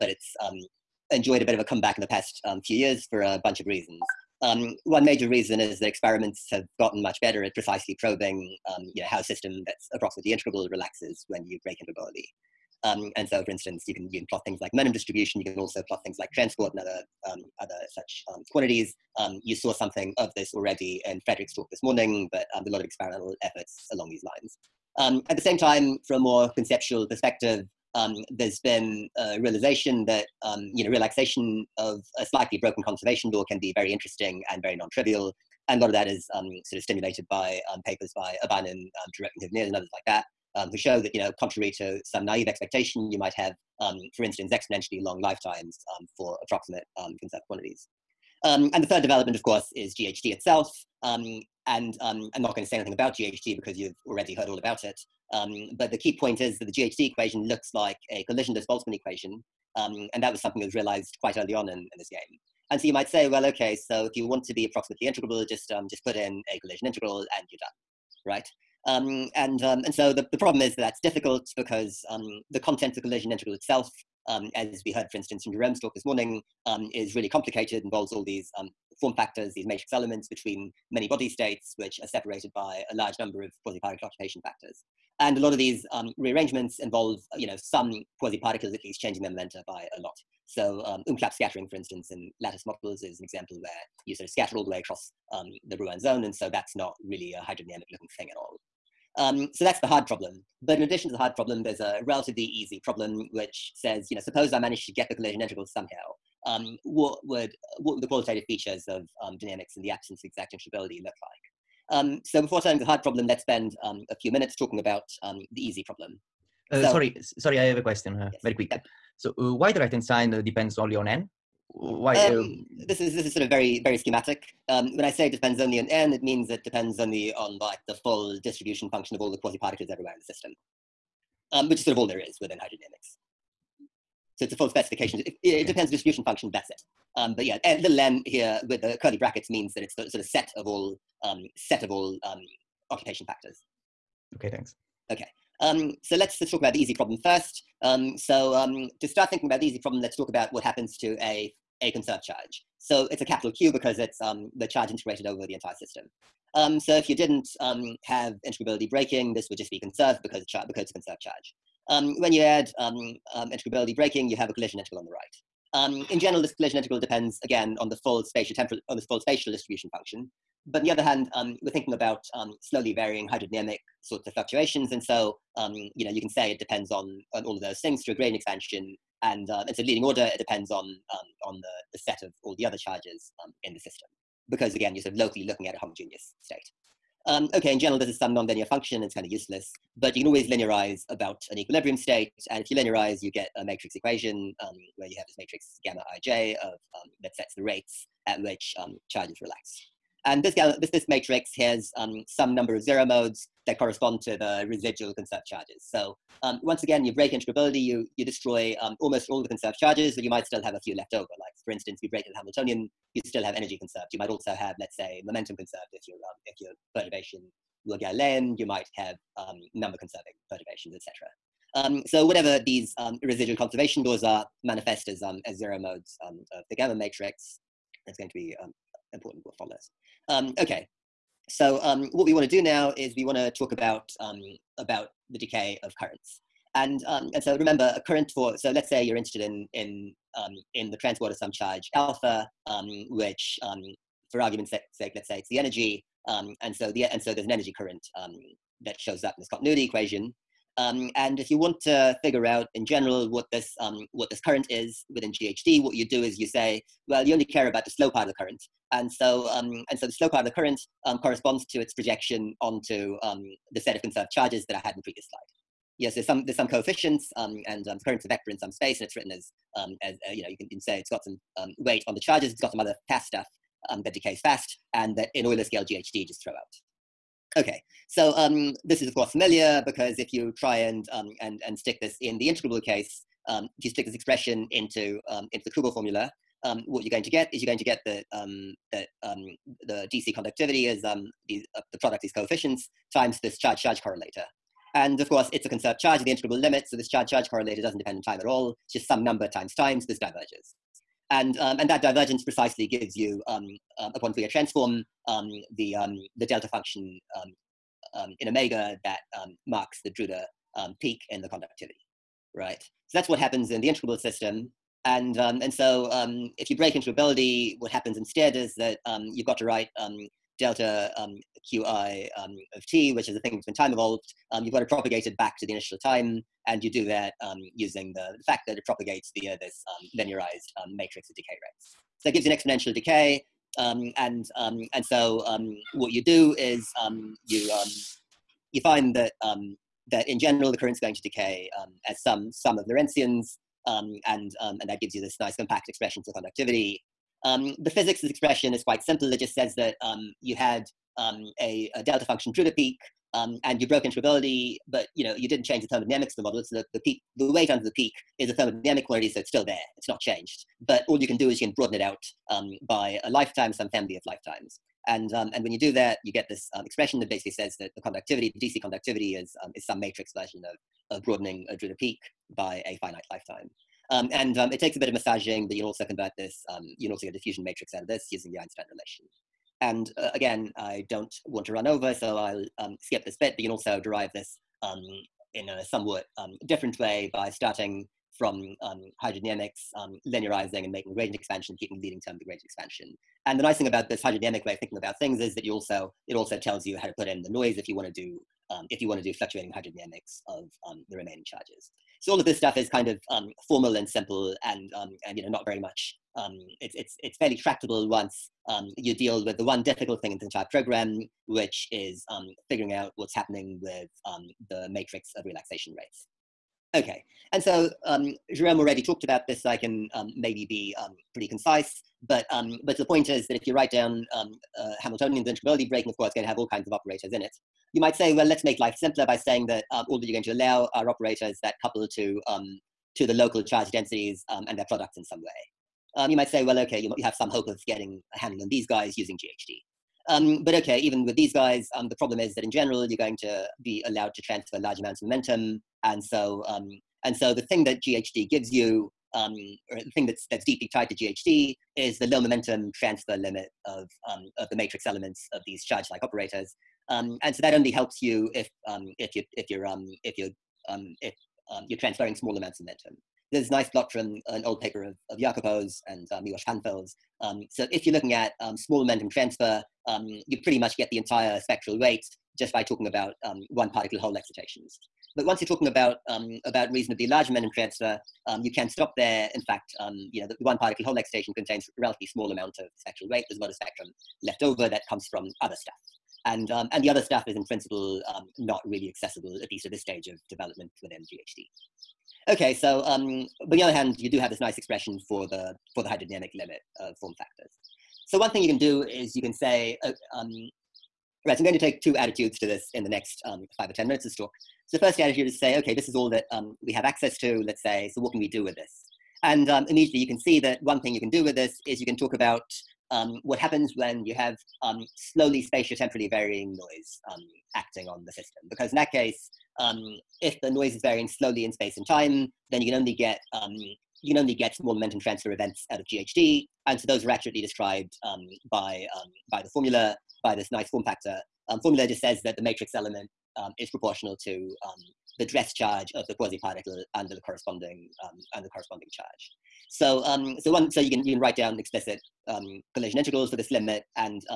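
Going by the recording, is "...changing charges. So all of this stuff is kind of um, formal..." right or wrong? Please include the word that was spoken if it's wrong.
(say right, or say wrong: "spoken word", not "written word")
wrong: "remaining", not "changing".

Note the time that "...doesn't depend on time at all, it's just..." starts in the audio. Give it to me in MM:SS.
04:57.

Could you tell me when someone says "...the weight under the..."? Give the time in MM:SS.
05:57.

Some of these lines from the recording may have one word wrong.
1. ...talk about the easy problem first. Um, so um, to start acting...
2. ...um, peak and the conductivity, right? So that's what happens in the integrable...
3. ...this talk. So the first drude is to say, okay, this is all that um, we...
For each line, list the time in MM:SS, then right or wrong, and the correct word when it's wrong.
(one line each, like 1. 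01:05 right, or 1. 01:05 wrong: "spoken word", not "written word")
1. 02:26 wrong: "thinking", not "acting"
2. 05:10 right
3. 08:24 wrong: "attitude", not "drude".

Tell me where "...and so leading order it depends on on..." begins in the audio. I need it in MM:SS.
02:59.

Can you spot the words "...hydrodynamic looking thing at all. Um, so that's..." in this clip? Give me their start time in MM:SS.
01:37.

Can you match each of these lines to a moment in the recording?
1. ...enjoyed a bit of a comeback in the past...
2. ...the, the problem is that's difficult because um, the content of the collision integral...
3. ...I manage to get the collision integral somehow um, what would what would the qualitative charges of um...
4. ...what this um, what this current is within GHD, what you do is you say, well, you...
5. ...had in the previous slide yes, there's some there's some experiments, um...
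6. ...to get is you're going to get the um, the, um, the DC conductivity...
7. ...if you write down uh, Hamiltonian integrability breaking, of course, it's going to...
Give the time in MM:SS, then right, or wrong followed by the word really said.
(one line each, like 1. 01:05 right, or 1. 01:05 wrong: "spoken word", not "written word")
1. 00:01 right
2. 01:10 right
3. 01:44 wrong: "features", not "charges"
4. 04:13 right
5. 04:24 wrong: "coefficients", not "experiments"
6. 04:47 right
7. 07:03 right.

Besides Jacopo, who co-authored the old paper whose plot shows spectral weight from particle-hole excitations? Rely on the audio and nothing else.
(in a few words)
Miłosz.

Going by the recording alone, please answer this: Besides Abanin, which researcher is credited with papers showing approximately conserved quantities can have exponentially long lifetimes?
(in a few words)
Huveneers.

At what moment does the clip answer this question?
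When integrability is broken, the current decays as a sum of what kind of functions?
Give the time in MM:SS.
05:42.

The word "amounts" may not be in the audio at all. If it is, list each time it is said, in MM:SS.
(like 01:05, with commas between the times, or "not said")
07:24, 07:42, 08:02.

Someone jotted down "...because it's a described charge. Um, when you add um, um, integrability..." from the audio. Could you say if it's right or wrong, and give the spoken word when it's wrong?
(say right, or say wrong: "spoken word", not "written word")
wrong: "conserved", not "described".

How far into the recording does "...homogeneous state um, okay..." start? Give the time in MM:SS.
03:05.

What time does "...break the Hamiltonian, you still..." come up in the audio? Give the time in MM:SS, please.
03:32.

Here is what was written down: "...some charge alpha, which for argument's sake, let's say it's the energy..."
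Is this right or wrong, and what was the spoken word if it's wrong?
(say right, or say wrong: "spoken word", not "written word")
right.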